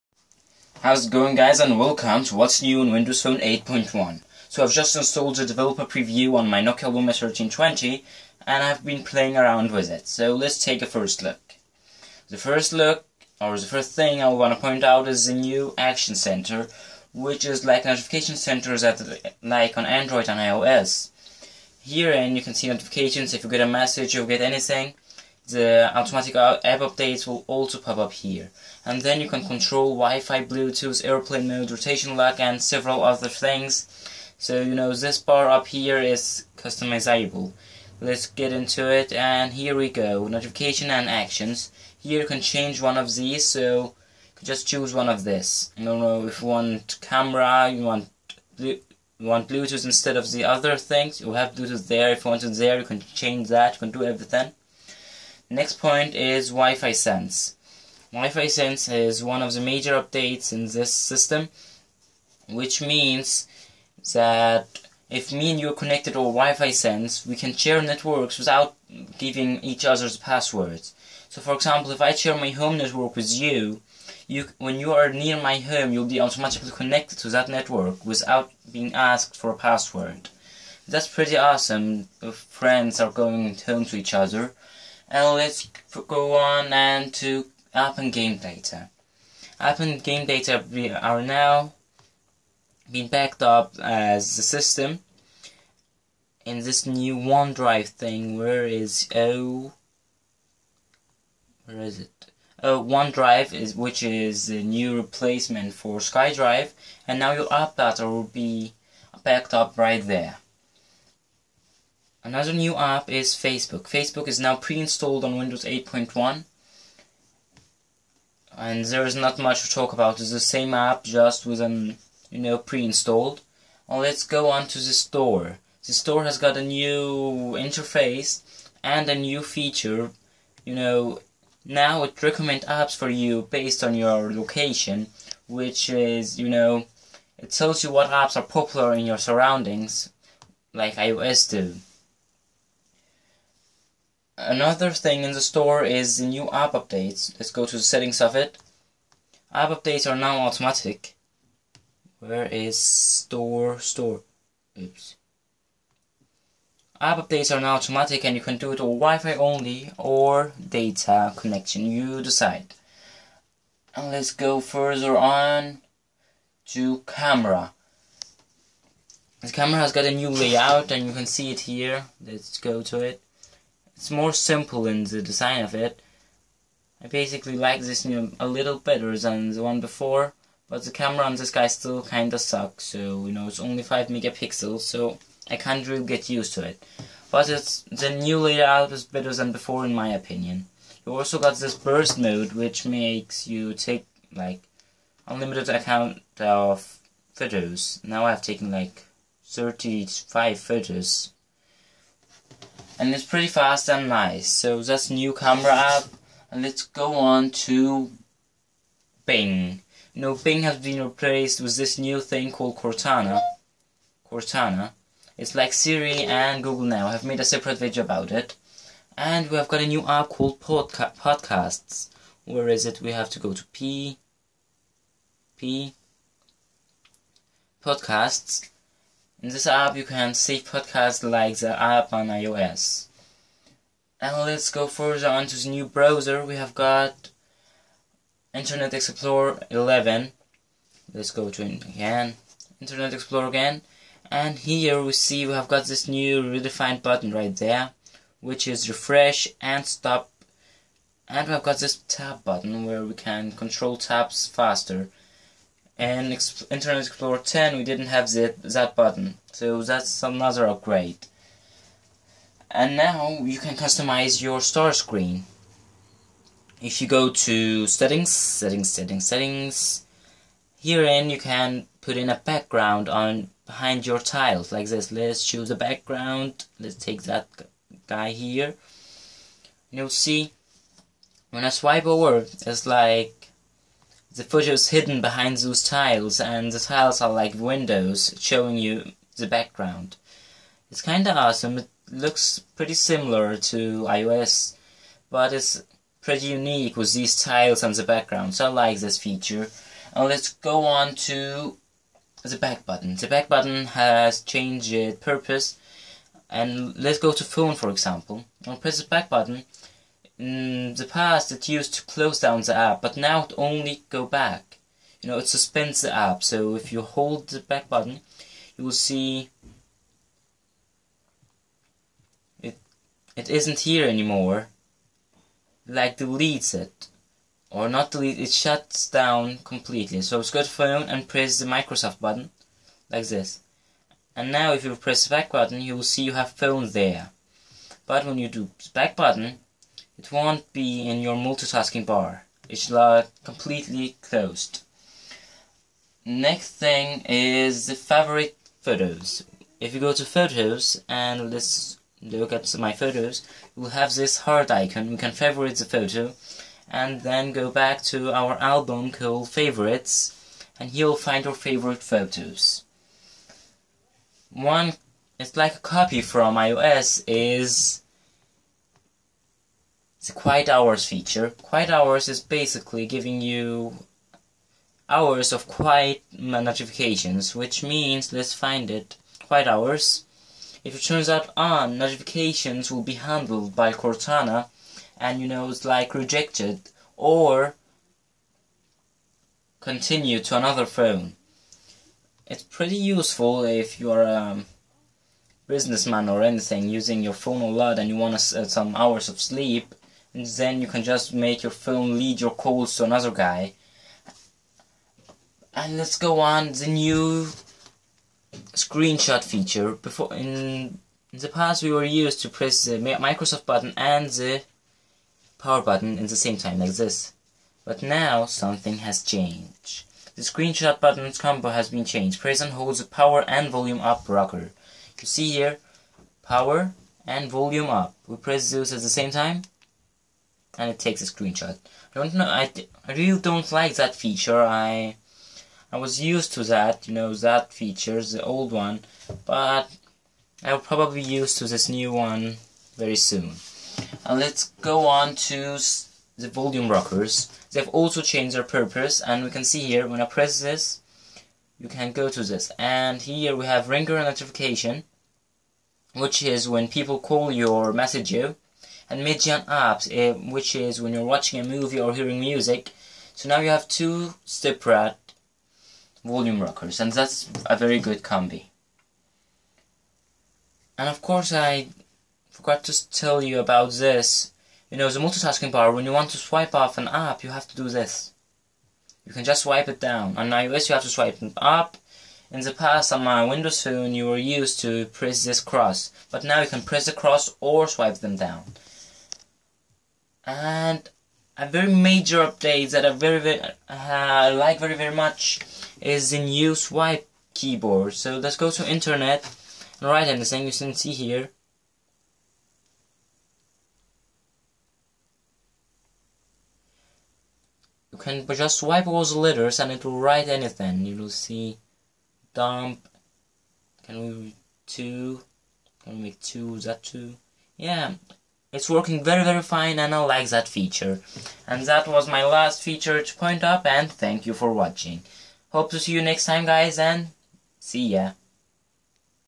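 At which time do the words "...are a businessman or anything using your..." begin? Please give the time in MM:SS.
06:34.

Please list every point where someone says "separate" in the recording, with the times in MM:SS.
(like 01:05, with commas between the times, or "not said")
03:37, 07:44.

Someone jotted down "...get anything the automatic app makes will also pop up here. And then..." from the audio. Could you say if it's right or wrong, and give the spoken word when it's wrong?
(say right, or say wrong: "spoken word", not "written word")
wrong: "updates", not "makes".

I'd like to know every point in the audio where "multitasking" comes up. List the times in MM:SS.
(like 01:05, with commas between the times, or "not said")
05:41, 07:55.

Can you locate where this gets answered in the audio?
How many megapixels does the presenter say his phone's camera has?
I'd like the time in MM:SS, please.
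03:03.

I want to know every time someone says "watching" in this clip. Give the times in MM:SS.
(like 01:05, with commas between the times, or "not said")
07:41, 08:44.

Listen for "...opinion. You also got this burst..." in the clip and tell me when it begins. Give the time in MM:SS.
03:10.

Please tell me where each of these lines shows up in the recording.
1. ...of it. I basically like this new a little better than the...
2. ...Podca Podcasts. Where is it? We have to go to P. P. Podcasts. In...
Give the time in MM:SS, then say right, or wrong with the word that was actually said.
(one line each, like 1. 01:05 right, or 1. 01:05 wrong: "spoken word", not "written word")
1. 02:55 right
2. 03:40 right.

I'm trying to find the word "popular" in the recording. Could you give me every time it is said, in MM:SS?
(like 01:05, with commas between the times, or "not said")
02:18.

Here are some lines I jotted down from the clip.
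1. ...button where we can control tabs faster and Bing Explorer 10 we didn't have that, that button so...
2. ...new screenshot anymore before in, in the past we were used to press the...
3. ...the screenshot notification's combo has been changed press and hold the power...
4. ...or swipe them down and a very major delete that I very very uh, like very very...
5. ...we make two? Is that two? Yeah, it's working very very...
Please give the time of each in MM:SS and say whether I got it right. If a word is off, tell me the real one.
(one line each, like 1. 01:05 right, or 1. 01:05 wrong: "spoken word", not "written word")
1. 04:12 wrong: "Internet", not "Bing"
2. 06:46 wrong: "feature", not "anymore"
3. 07:00 wrong: "button", not "notification"
4. 08:07 wrong: "update", not "delete"
5. 08:36 right.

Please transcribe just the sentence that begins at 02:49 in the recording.
The camera has got a new layout and you can see it here.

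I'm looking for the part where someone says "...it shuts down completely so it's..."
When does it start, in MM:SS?
05:28.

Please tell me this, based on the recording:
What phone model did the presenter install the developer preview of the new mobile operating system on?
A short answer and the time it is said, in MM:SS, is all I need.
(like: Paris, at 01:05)
Nokia Lumia 1320, at 00:06.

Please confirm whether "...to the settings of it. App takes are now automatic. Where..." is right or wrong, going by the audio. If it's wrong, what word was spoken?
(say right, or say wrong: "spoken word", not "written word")
wrong: "updates", not "takes".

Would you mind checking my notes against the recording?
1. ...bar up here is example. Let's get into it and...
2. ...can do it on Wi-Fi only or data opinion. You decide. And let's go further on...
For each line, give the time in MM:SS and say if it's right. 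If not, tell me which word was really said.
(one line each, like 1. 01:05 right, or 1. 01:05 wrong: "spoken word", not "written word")
1. 00:35 wrong: "customizable", not "example"
2. 02:38 wrong: "connection", not "opinion".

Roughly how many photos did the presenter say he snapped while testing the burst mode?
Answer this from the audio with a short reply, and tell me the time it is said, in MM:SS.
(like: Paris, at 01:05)
35, at 03:19.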